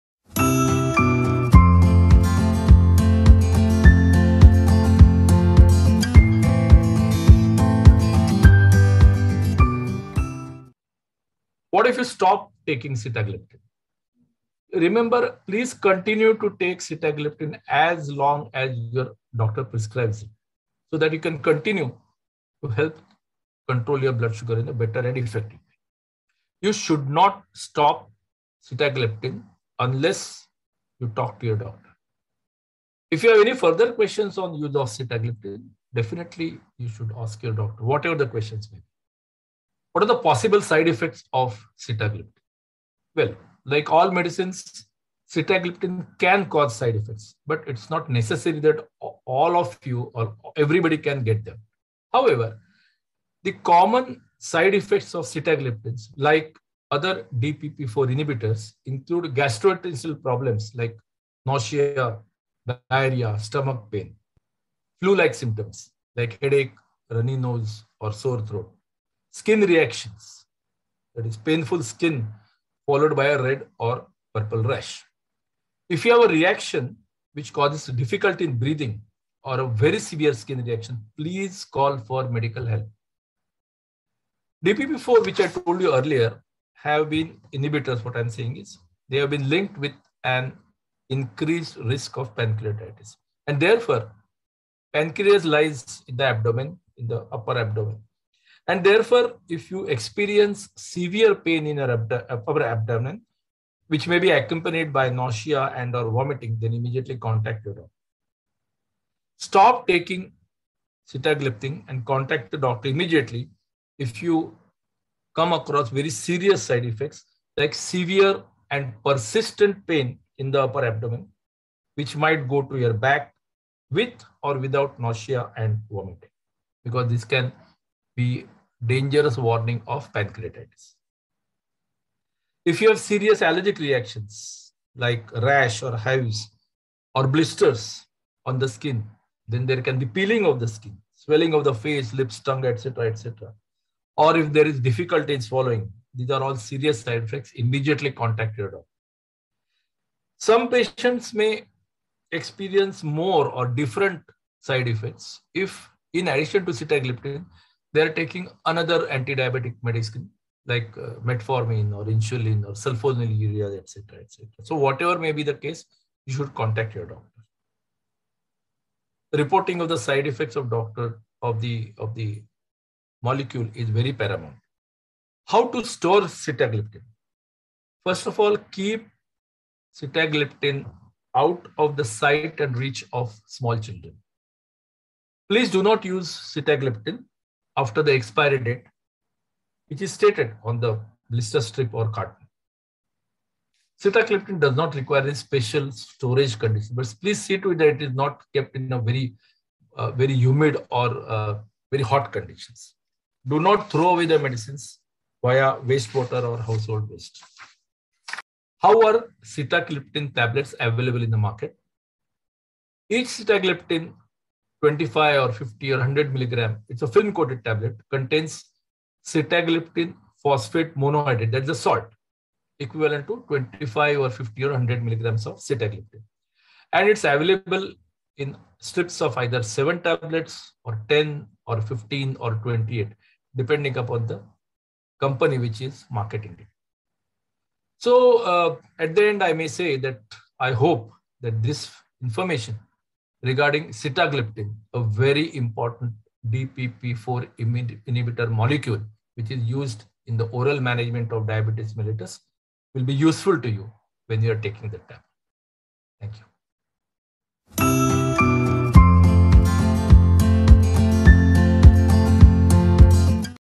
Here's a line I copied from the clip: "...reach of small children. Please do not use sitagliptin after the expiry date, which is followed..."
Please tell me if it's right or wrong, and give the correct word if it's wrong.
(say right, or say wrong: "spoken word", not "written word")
wrong: "stated", not "followed".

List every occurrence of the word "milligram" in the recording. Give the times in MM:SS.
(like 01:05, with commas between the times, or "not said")
03:36, 03:45.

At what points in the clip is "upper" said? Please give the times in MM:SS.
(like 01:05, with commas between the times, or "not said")
01:37, 01:42, 02:00.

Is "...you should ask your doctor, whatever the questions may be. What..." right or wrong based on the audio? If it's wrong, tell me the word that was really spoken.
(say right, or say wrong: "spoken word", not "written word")
right.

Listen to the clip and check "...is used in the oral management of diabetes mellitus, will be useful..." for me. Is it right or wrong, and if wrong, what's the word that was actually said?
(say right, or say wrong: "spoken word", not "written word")
right.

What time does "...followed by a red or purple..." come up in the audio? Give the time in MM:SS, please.
01:12.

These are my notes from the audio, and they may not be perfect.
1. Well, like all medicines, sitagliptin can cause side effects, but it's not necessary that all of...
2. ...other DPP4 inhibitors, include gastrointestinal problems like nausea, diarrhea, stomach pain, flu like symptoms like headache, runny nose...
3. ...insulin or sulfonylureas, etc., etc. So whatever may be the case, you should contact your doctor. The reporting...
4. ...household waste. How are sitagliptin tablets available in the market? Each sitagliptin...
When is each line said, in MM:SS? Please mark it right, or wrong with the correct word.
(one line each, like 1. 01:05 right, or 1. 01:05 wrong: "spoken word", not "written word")
1. 00:43 right
2. 00:56 right
3. 02:42 right
4. 03:26 right.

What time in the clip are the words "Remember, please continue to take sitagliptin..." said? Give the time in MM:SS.
00:14.